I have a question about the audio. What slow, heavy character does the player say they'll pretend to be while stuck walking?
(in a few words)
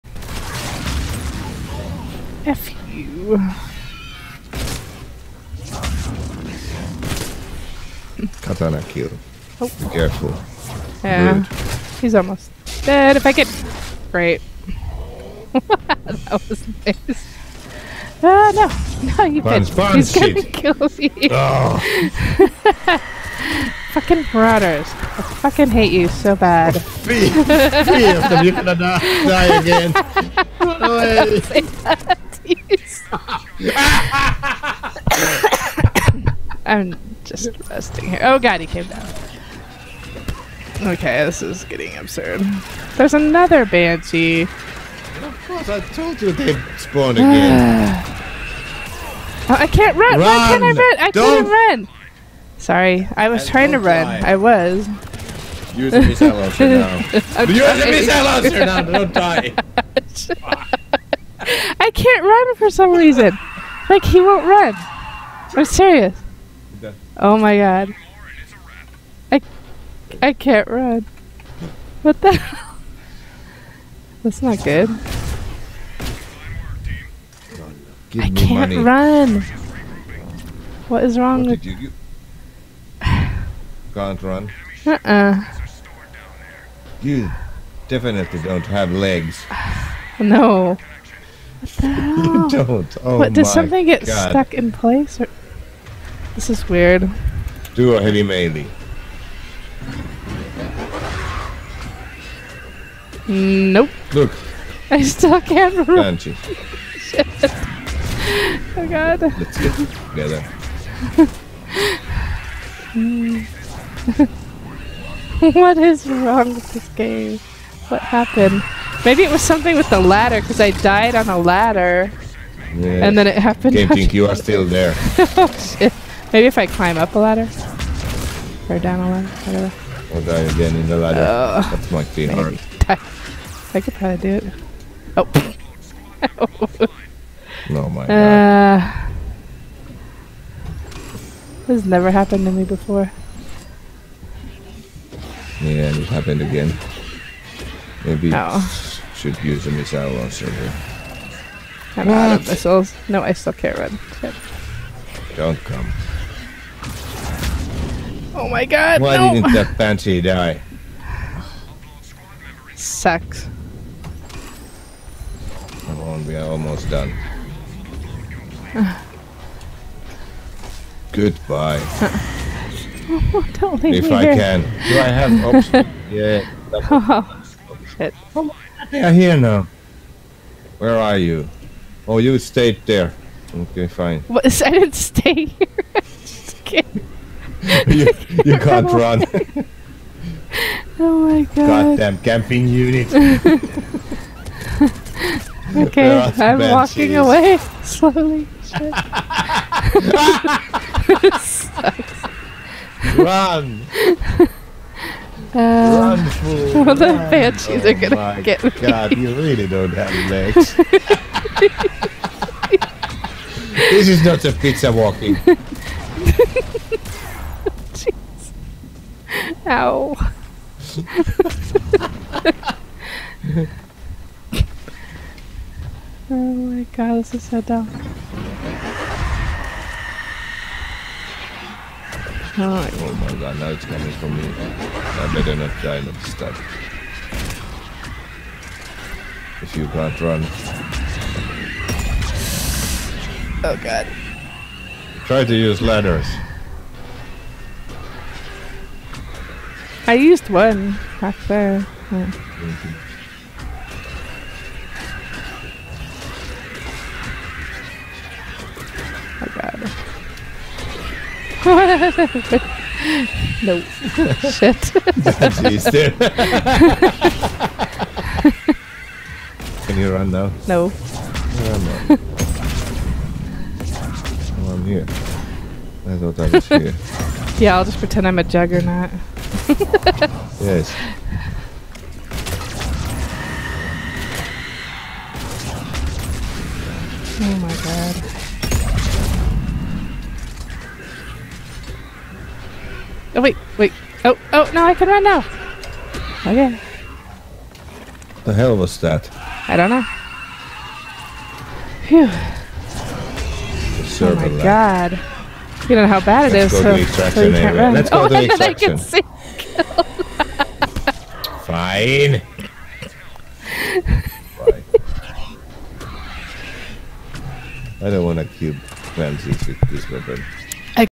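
Juggernaut.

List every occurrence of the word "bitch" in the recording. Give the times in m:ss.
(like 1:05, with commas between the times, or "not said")
0:19.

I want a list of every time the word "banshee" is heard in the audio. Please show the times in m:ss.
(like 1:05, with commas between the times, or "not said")
0:43, 3:27.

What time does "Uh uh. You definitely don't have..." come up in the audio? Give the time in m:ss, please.
1:24.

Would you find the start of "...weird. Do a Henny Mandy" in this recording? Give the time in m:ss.
1:36.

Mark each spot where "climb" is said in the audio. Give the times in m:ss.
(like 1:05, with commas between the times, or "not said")
2:06.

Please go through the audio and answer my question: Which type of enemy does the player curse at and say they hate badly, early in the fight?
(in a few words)
Marauders.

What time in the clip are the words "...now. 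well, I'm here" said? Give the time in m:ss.
4:31.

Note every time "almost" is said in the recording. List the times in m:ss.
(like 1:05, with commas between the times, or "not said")
0:12, 2:46.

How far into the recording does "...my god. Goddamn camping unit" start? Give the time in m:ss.
3:11.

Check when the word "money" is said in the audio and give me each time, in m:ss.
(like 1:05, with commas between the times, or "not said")
1:18.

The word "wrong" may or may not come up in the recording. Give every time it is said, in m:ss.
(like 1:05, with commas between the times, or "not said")
1:21, 1:56.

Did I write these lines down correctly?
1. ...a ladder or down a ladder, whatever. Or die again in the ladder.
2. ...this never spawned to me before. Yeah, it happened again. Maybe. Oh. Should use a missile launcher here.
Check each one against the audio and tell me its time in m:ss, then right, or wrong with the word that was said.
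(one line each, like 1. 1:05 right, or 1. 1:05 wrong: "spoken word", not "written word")
1. 2:07 right
2. 2:21 wrong: "happened", not "spawned".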